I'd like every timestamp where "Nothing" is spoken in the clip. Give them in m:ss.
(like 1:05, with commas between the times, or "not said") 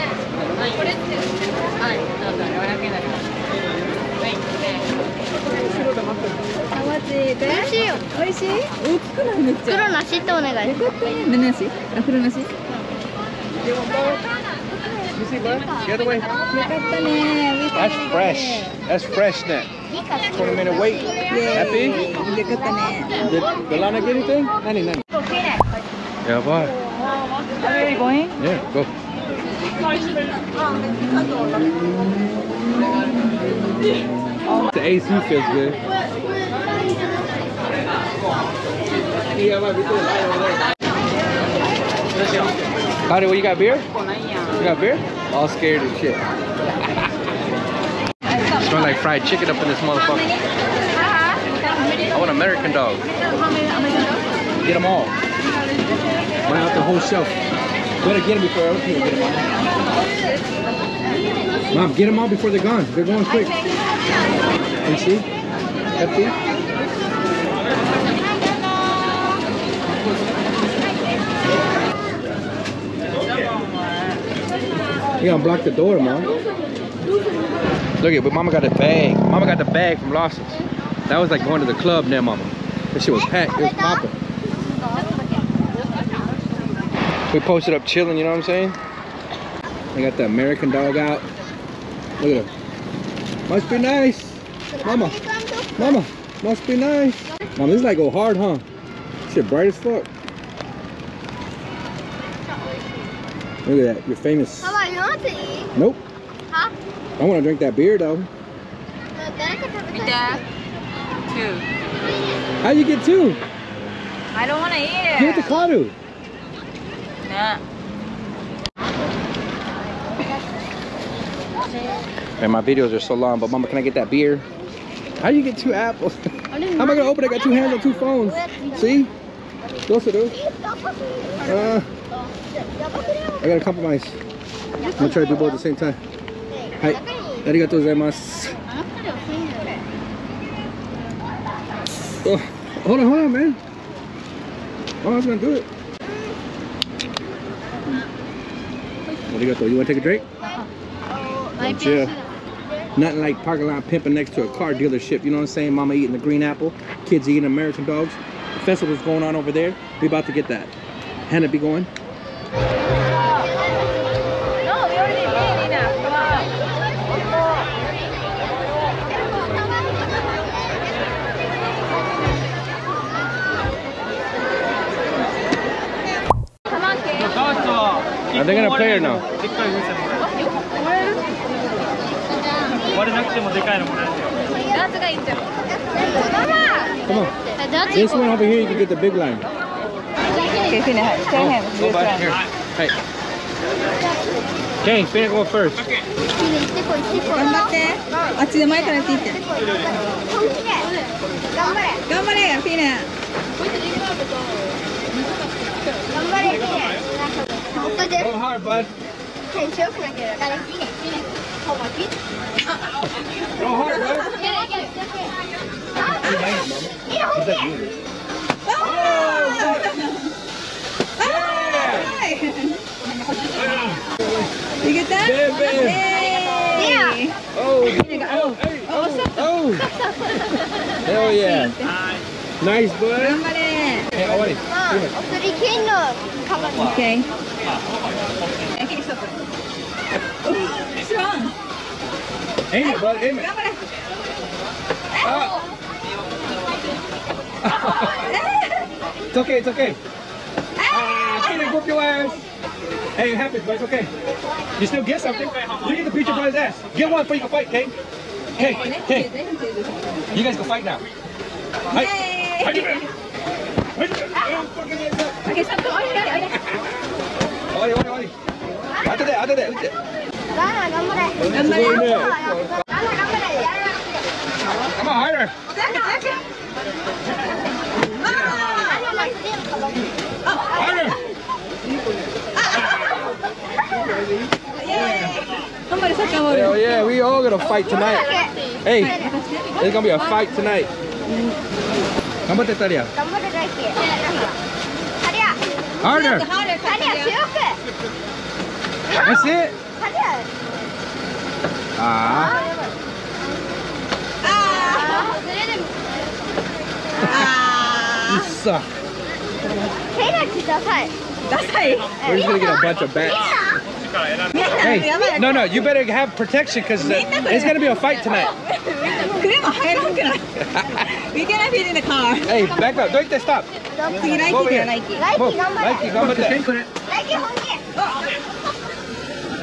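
2:32.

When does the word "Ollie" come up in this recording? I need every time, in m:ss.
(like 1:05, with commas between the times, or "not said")
3:54.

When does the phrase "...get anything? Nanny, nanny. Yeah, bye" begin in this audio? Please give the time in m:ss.
0:24.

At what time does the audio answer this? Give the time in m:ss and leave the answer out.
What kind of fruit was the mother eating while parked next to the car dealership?
2:36.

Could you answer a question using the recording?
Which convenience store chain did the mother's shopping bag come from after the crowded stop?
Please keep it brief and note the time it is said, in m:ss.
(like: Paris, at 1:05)
Lawson, at 1:20.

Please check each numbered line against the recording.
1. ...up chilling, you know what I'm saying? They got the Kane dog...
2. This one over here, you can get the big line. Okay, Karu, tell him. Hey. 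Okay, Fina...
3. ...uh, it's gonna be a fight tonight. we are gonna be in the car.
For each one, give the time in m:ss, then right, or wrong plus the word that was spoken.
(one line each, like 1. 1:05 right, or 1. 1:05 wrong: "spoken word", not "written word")
1. 1:27 wrong: "American", not "Kane"
2. 3:07 wrong: "Fina", not "Karu"
3. 5:17 right.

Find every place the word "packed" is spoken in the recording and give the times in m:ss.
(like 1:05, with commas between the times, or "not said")
1:23.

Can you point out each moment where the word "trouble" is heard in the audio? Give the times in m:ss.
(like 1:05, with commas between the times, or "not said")
not said.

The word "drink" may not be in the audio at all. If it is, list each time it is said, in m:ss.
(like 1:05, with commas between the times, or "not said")
1:47, 2:30.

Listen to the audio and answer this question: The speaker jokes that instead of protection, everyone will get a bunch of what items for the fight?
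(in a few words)
Bats.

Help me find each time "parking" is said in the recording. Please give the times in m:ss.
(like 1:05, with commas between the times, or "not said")
2:33.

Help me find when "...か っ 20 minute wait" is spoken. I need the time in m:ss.
0:19.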